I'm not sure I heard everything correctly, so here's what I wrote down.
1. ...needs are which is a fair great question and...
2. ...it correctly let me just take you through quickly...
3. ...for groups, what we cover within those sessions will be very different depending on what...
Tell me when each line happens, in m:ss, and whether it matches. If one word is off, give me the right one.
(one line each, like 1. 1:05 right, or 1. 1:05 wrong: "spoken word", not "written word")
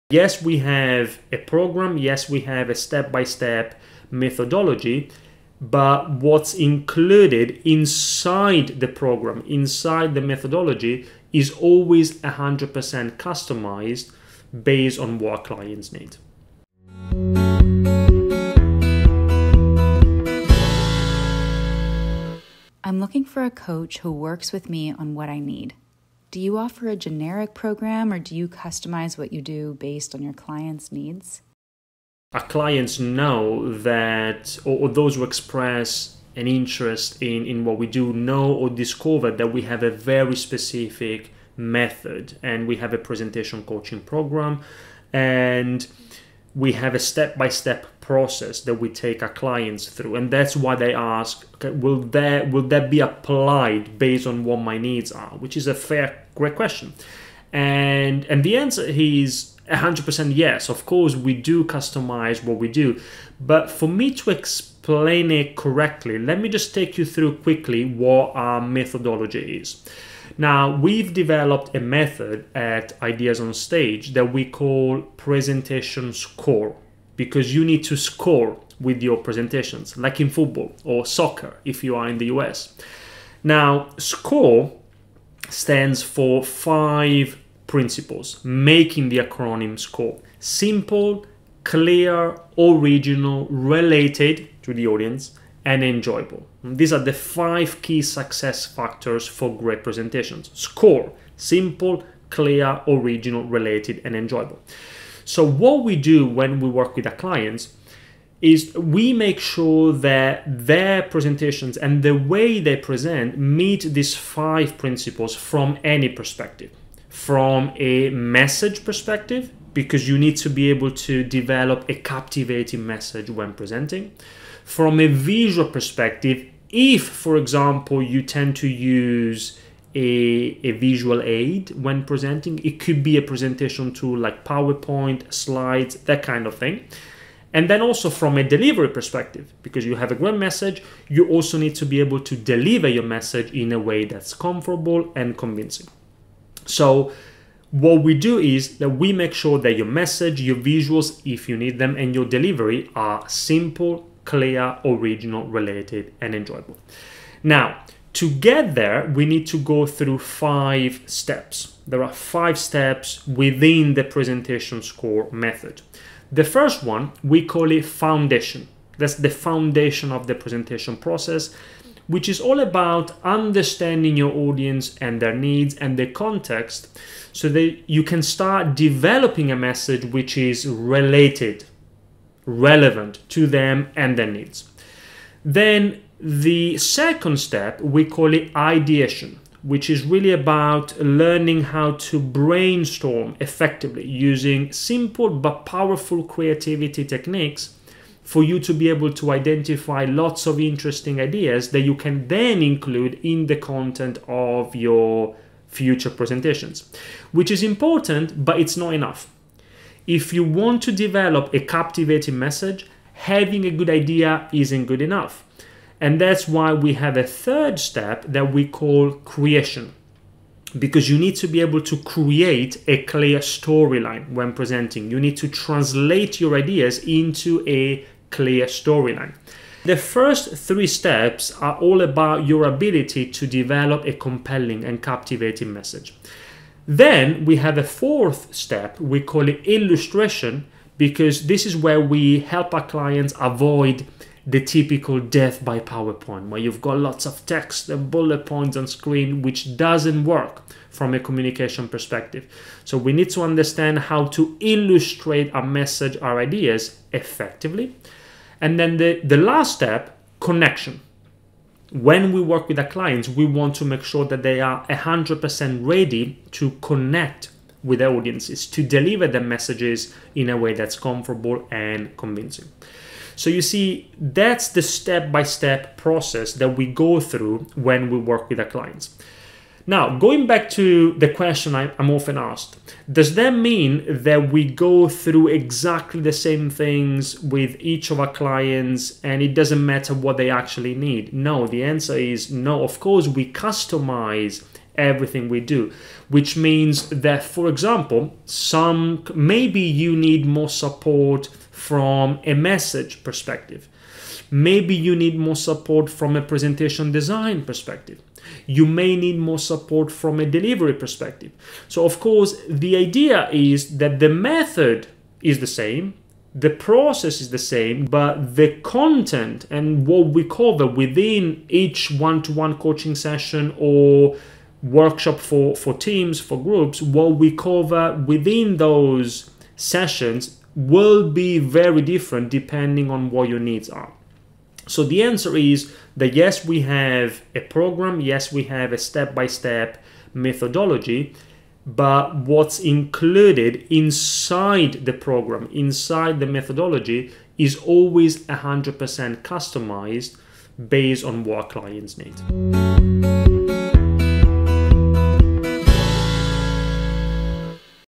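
1. 0:54 right
2. 1:05 right
3. 5:26 right.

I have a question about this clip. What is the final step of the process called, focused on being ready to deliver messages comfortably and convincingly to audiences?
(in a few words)
Connection.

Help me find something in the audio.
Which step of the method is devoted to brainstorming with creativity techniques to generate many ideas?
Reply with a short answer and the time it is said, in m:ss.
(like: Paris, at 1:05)
Ideation, at 3:08.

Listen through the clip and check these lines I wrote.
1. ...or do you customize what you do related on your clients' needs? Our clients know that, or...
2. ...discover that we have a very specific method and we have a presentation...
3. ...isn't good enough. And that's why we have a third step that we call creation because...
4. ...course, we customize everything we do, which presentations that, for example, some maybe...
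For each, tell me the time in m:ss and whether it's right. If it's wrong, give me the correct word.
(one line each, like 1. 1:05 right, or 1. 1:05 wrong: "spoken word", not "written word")
1. 0:28 wrong: "based", not "related"
2. 0:38 right
3. 3:34 right
4. 4:52 wrong: "means", not "presentations".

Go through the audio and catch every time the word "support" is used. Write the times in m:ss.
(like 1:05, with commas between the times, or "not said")
5:00, 5:05, 5:09.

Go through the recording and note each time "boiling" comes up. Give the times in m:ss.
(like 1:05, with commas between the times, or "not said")
not said.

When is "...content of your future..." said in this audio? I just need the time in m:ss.
3:23.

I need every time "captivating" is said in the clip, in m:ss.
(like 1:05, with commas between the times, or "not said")
2:01, 3:31, 3:55.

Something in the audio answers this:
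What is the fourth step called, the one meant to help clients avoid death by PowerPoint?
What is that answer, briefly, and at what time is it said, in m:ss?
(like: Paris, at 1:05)
Illustration, at 3:59.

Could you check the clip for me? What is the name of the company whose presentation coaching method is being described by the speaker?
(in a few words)
Ideas on Stage.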